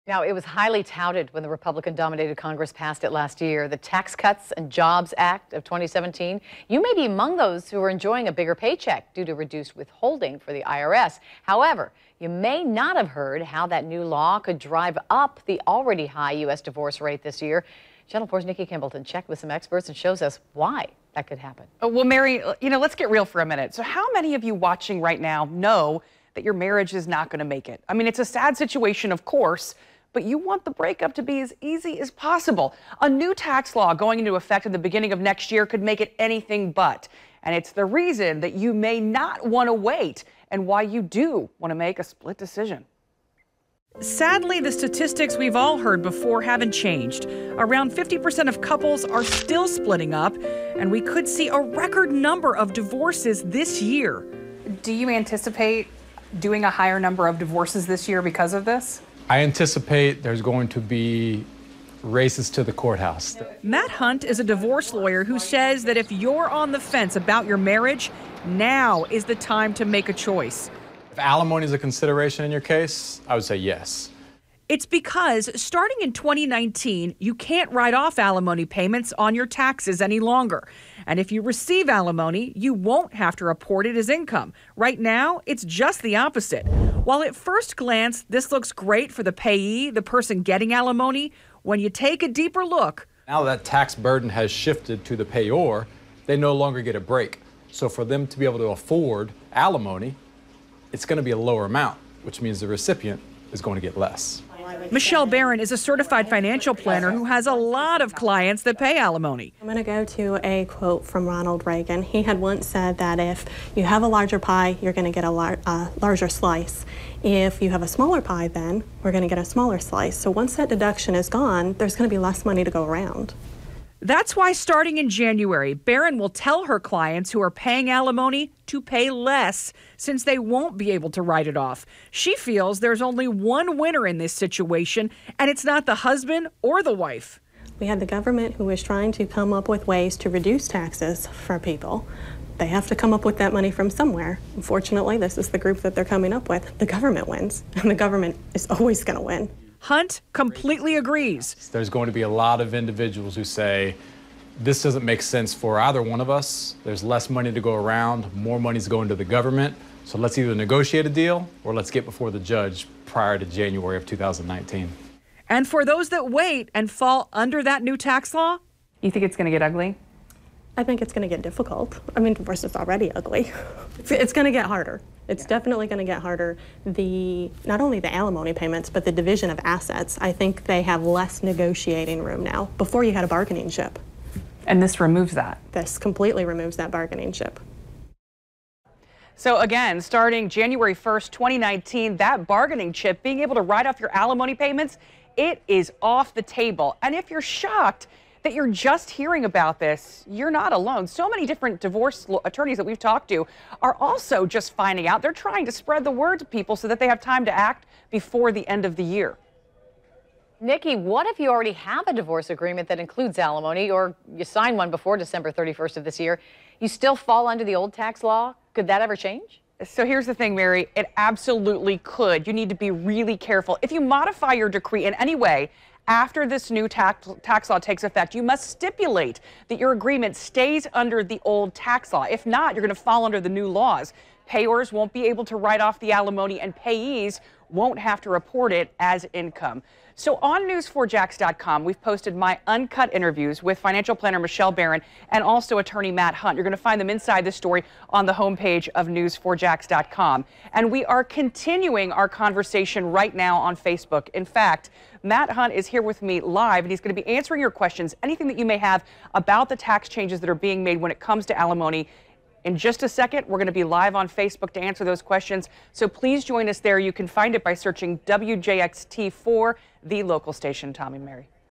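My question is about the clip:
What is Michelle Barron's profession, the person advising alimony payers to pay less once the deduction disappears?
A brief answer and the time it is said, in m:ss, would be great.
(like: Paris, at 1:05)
certified financial planner, at 1:45.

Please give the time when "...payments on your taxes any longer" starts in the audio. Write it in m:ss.
1:18.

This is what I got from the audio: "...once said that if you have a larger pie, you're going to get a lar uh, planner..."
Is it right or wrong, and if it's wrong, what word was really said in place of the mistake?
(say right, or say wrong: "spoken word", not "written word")
wrong: "larger", not "planner".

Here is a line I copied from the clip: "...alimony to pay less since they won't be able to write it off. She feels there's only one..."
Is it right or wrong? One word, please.
right.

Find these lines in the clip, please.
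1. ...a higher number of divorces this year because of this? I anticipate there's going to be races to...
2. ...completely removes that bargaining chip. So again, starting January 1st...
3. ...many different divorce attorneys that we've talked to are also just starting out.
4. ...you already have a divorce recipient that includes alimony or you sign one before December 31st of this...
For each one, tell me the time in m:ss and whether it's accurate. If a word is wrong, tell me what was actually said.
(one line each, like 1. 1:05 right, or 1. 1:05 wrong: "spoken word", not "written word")
1. 0:56 right
2. 3:05 right
3. 3:21 wrong: "finding", not "starting"
4. 3:31 wrong: "agreement", not "recipient".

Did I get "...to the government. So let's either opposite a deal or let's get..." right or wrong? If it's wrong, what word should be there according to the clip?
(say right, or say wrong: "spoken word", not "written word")
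wrong: "negotiate", not "opposite".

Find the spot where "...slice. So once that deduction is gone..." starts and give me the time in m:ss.
1:59.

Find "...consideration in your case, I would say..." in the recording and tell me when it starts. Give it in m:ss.
1:11.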